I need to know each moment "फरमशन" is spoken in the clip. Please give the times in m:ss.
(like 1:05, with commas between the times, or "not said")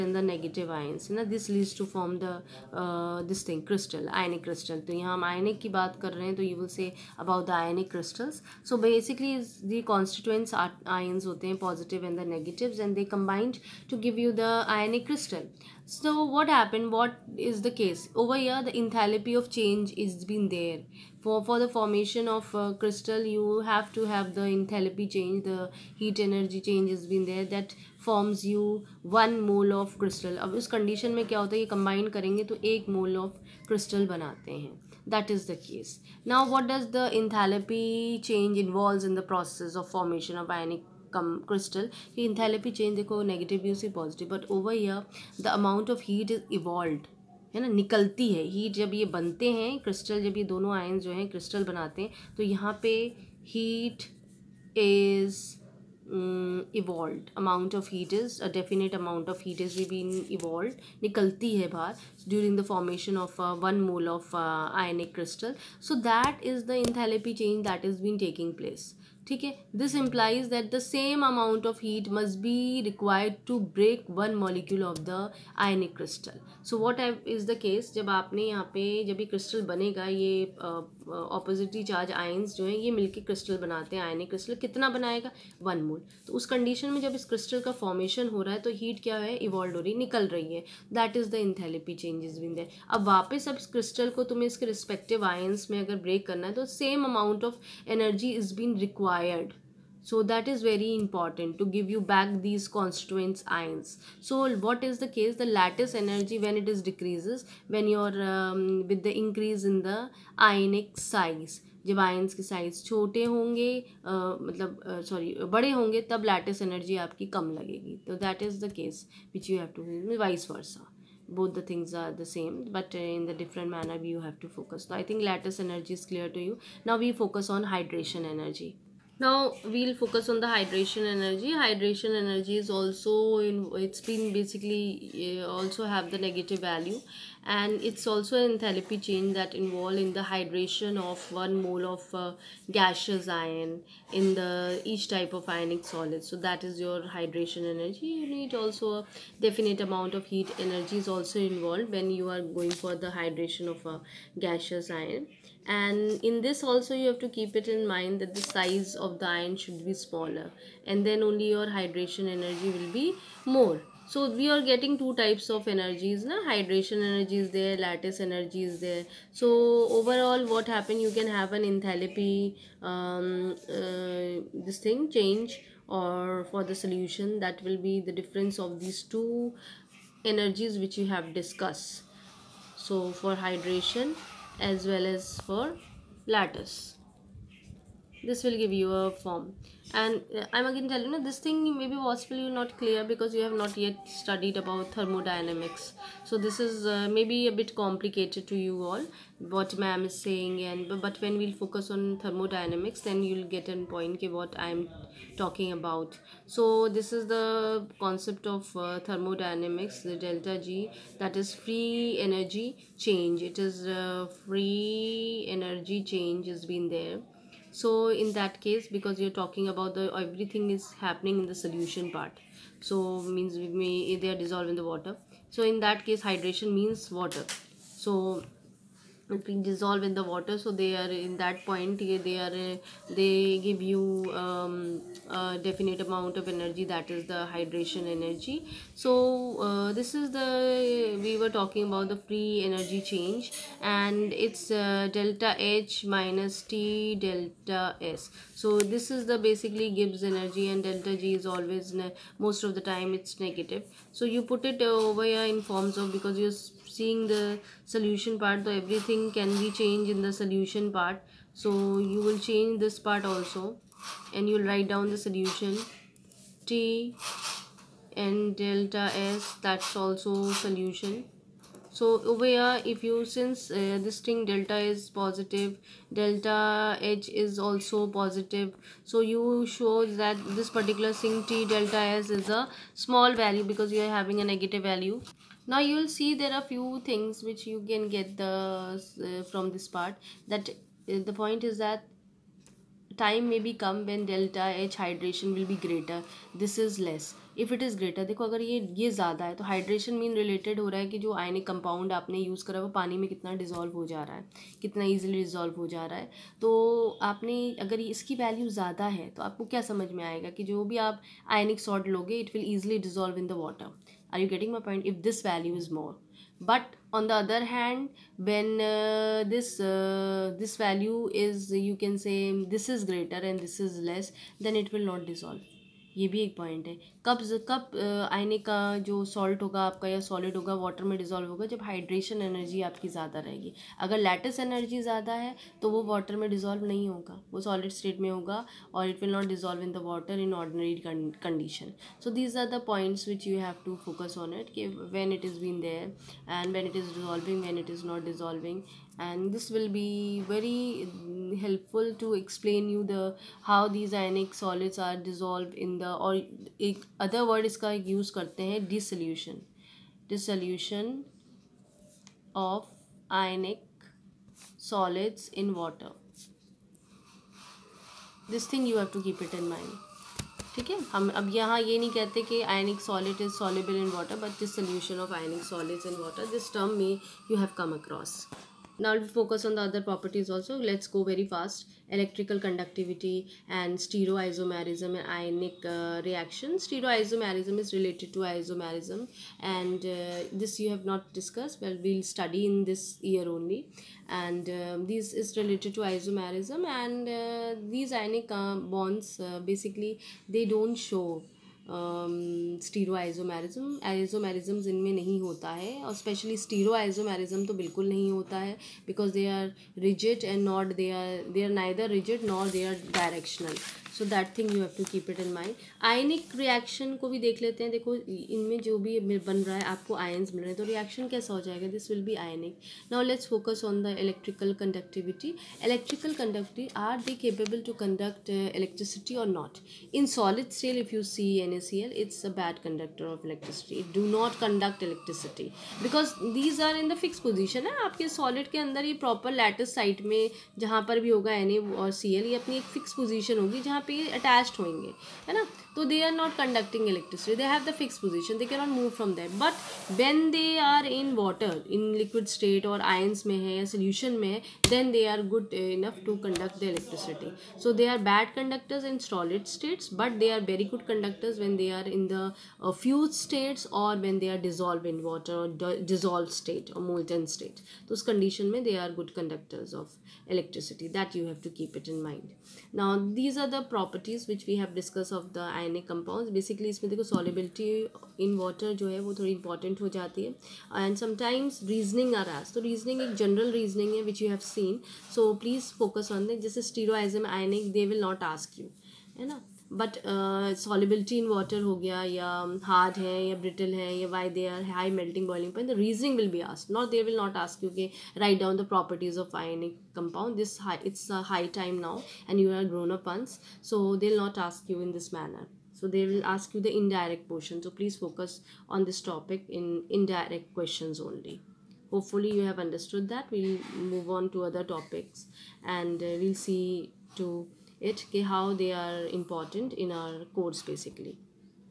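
1:02, 1:27.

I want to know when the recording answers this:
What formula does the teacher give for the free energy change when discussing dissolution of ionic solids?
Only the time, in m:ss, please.
4:05.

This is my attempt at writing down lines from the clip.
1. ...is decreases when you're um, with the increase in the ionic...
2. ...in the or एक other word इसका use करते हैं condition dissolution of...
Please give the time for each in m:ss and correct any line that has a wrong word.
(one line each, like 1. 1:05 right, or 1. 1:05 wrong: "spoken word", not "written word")
1. 1:46 right
2. 5:55 wrong: "dissolution", not "condition".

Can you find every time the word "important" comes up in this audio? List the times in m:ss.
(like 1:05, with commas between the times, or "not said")
1:40, 8:39.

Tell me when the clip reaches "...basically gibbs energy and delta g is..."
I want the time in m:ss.
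4:09.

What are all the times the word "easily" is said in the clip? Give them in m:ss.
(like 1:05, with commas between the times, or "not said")
5:05, 5:12.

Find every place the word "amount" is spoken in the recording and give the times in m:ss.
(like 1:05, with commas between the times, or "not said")
0:45, 2:29, 3:56.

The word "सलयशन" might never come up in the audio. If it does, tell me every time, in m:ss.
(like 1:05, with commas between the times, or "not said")
6:14.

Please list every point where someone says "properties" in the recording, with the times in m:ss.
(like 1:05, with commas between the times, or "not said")
6:20, 7:53.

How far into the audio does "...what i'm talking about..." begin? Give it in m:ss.
3:24.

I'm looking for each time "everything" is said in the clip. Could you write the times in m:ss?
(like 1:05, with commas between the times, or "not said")
3:40, 4:18.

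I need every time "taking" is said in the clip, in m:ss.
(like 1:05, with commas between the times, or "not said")
not said.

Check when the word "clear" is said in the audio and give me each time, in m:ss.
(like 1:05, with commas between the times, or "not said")
2:06, 3:12.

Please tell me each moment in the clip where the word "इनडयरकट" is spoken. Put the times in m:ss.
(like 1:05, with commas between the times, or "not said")
8:27.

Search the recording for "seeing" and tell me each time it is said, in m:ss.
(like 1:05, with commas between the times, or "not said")
4:16.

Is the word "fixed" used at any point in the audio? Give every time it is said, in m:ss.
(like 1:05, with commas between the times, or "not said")
7:27.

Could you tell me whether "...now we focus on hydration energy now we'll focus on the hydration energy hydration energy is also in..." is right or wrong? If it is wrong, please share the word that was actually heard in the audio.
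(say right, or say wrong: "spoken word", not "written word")
right.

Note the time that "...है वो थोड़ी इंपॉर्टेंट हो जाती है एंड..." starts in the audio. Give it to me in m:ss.
7:59.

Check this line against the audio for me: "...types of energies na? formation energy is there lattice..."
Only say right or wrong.
wrong.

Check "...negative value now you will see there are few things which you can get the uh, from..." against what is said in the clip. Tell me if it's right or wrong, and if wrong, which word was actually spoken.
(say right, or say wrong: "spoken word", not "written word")
right.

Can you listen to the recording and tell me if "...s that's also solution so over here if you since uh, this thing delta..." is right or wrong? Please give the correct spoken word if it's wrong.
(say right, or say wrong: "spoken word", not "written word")
right.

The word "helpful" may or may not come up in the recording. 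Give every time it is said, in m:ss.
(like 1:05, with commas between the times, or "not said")
5:51.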